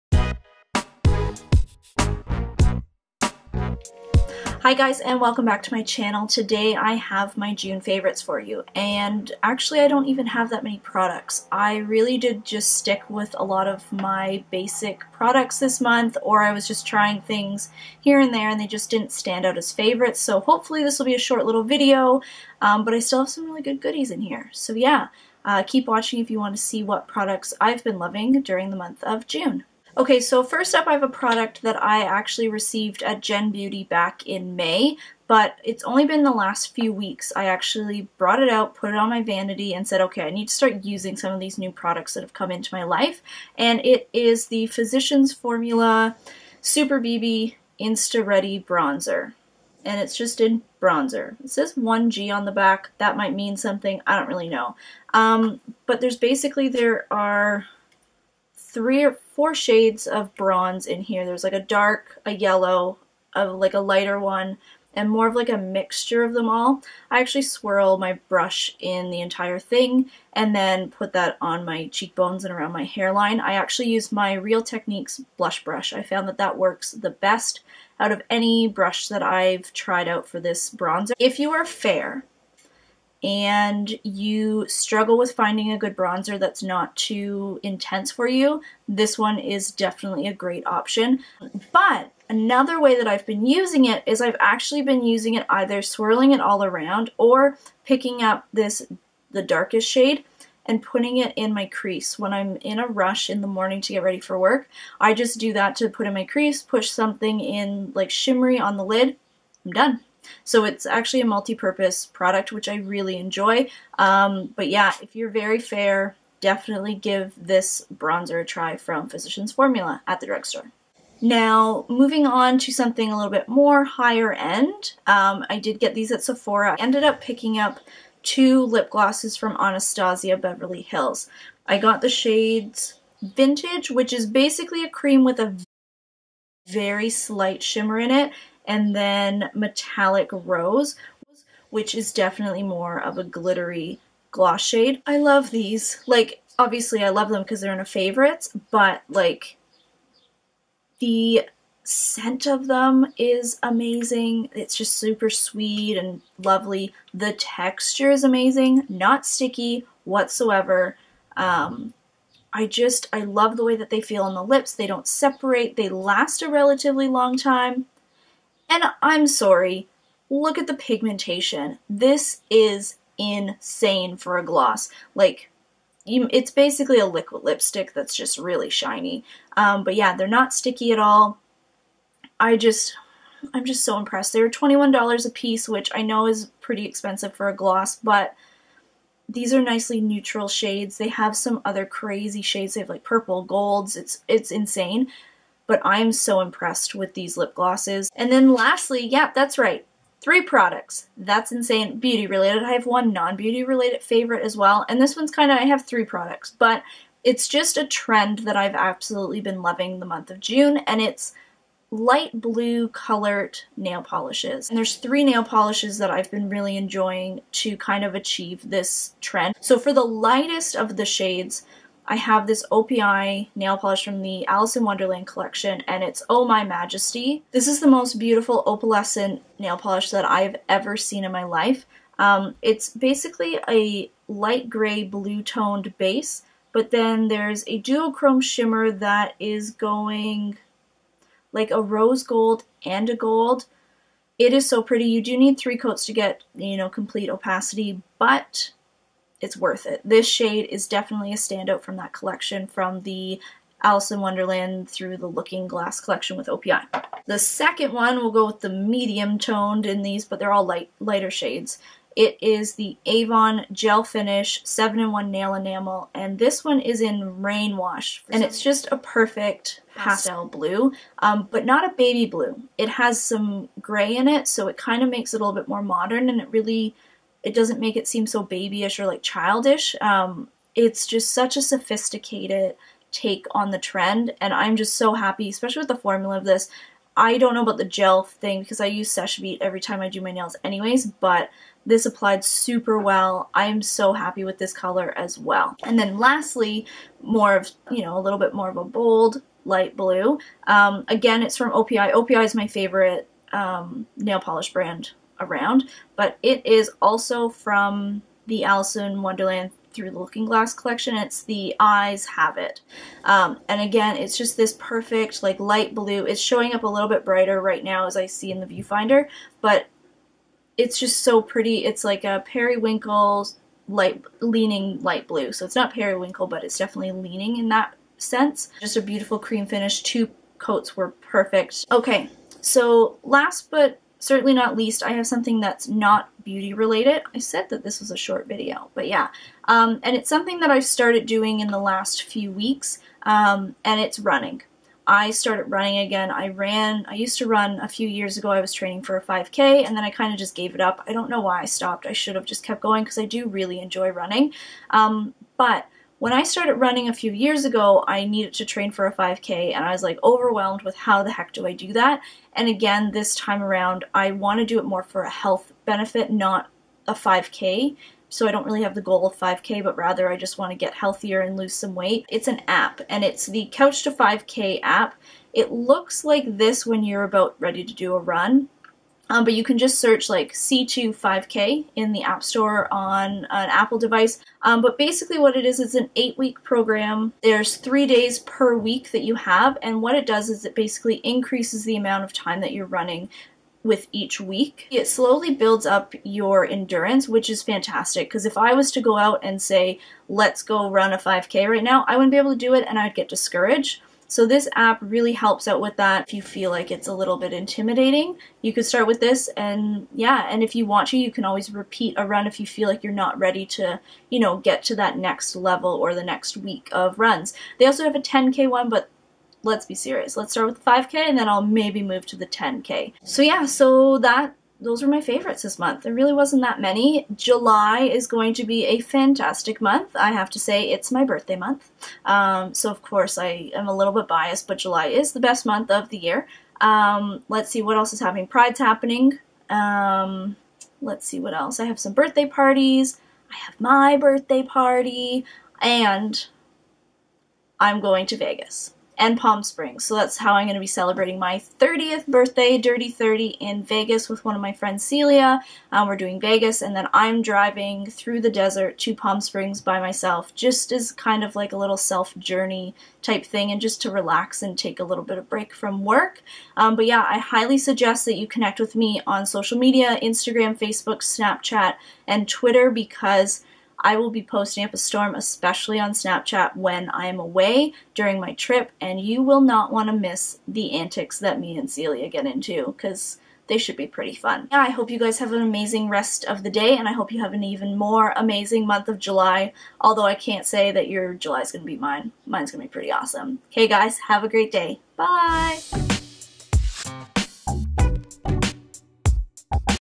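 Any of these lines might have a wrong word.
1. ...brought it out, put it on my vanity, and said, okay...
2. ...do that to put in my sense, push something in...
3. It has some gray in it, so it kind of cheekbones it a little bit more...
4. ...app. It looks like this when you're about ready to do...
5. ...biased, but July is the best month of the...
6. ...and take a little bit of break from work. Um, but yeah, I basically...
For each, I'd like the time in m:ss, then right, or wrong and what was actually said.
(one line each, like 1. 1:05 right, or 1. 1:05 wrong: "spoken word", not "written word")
1. 0:38 right
2. 1:45 wrong: "crease", not "sense"
3. 4:32 wrong: "makes", not "cheekbones"
4. 6:14 right
5. 7:14 right
6. 7:44 wrong: "highly", not "basically".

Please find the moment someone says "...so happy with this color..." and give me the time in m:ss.
4:53.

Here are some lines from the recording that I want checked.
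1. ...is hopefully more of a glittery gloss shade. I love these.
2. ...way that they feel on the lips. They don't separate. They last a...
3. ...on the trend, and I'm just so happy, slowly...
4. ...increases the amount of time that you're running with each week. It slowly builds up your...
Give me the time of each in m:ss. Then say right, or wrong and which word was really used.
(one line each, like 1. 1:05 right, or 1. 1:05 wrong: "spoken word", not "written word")
1. 2:21 wrong: "definitely", not "hopefully"
2. 2:43 right
3. 4:43 wrong: "especially", not "slowly"
4. 6:31 right.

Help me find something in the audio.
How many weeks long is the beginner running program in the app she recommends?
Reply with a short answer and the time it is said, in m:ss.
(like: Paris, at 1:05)
8, at 6:26.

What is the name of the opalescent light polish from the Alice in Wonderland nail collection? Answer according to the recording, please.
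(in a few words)
Oh My Majesty.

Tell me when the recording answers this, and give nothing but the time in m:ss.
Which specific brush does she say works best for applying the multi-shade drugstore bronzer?
1:14.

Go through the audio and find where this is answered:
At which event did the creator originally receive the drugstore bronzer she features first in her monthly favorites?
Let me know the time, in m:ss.
0:33.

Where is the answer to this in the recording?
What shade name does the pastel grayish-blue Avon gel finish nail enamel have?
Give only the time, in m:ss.
4:27.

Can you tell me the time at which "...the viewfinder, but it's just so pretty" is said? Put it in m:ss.
5:18.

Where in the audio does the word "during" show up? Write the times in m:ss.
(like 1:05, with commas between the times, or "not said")
0:28, 7:58.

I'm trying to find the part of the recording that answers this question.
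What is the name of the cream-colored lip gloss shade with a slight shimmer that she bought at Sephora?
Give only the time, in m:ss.
2:13.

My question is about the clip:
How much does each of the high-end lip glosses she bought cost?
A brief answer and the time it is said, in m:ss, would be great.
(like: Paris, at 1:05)
$21, at 3:04.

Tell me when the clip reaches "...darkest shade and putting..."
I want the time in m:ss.
1:39.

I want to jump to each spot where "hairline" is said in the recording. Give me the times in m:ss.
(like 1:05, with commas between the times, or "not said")
1:12.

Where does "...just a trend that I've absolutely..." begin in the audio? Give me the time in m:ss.
3:27.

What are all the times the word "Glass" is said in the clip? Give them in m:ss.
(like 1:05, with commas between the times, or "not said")
4:15, 5:10.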